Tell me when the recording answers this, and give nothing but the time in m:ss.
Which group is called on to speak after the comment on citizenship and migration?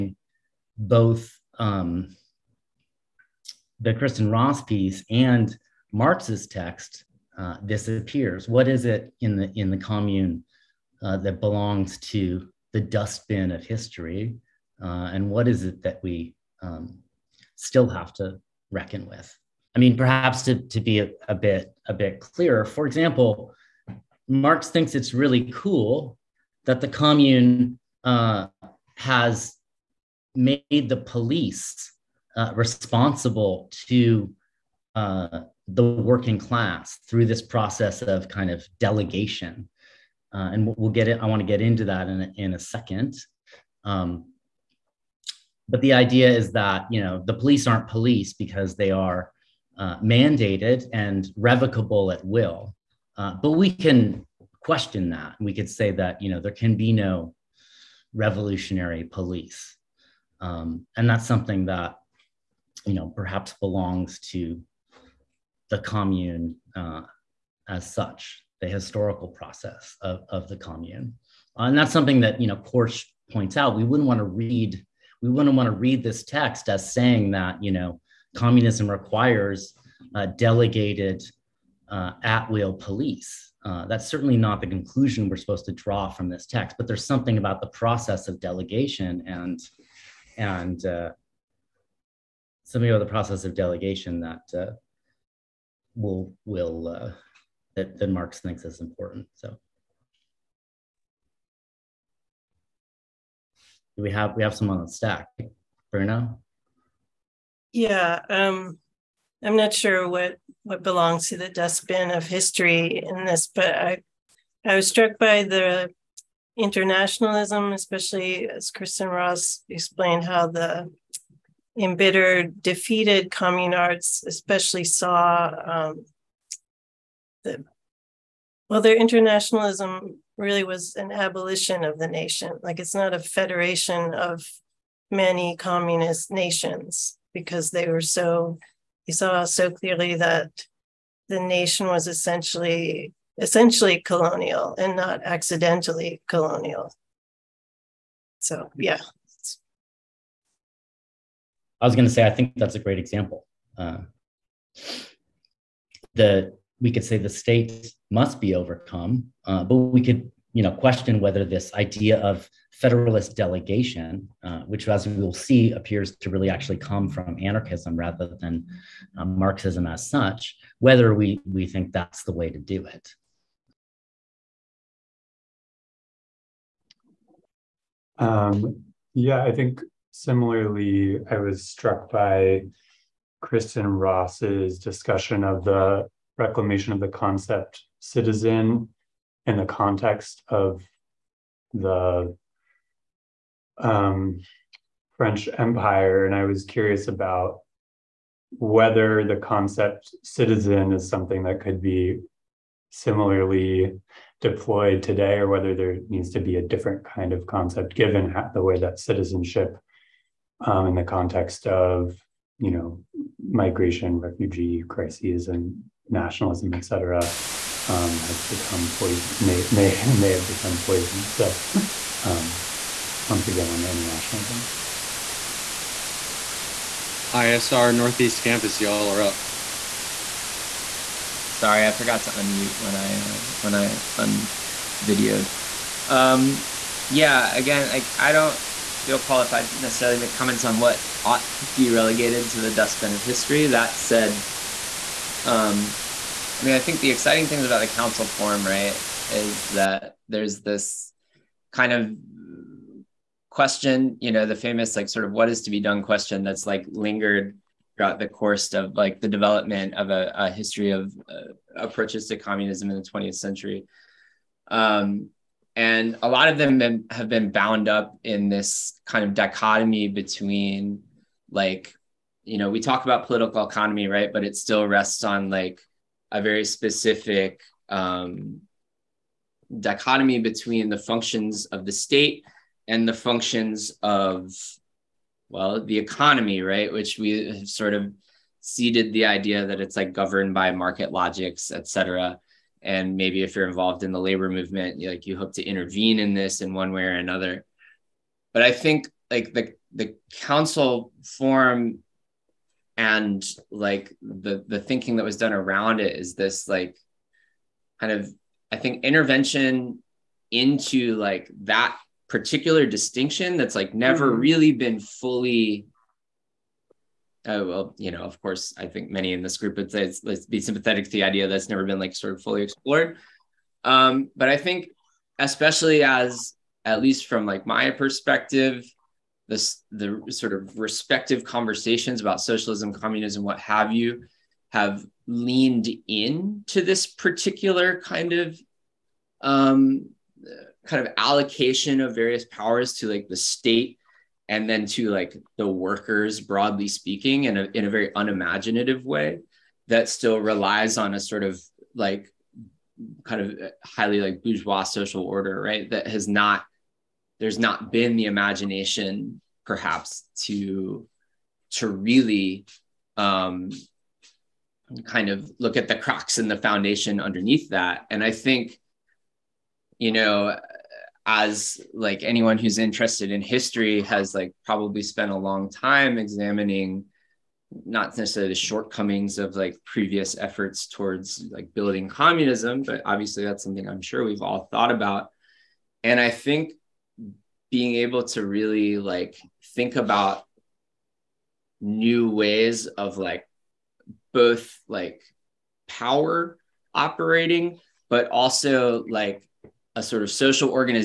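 3:47.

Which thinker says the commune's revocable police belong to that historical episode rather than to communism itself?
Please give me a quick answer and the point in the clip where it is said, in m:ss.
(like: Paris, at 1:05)
Korsch, at 1:12.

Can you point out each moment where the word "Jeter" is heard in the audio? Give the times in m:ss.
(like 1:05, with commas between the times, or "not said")
not said.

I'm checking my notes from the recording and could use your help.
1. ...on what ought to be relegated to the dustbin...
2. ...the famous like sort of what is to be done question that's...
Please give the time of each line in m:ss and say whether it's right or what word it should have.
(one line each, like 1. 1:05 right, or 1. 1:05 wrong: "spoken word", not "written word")
1. 4:00 right
2. 4:14 right.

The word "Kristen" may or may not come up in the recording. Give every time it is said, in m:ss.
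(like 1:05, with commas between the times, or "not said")
0:03, 1:58, 3:03.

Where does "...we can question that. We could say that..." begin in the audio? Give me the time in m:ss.
0:53.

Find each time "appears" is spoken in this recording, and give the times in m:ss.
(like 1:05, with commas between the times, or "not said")
0:07, 2:45.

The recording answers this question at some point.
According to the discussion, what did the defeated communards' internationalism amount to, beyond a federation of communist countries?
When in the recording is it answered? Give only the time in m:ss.
2:11.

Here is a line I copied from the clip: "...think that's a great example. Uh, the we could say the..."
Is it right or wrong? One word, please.
right.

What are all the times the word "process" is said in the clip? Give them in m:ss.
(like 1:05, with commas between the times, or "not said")
0:37, 1:09, 1:27, 1:33.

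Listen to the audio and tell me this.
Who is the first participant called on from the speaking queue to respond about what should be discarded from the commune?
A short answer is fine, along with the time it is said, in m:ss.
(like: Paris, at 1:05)
Bruno, at 1:45.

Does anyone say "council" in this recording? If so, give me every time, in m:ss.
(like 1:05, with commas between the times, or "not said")
4:07, 5:00.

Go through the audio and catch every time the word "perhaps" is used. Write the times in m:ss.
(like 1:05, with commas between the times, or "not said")
0:19, 1:03, 5:59.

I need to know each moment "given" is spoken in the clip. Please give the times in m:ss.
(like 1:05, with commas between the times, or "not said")
3:27.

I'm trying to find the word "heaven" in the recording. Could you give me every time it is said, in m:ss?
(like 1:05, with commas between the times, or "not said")
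not said.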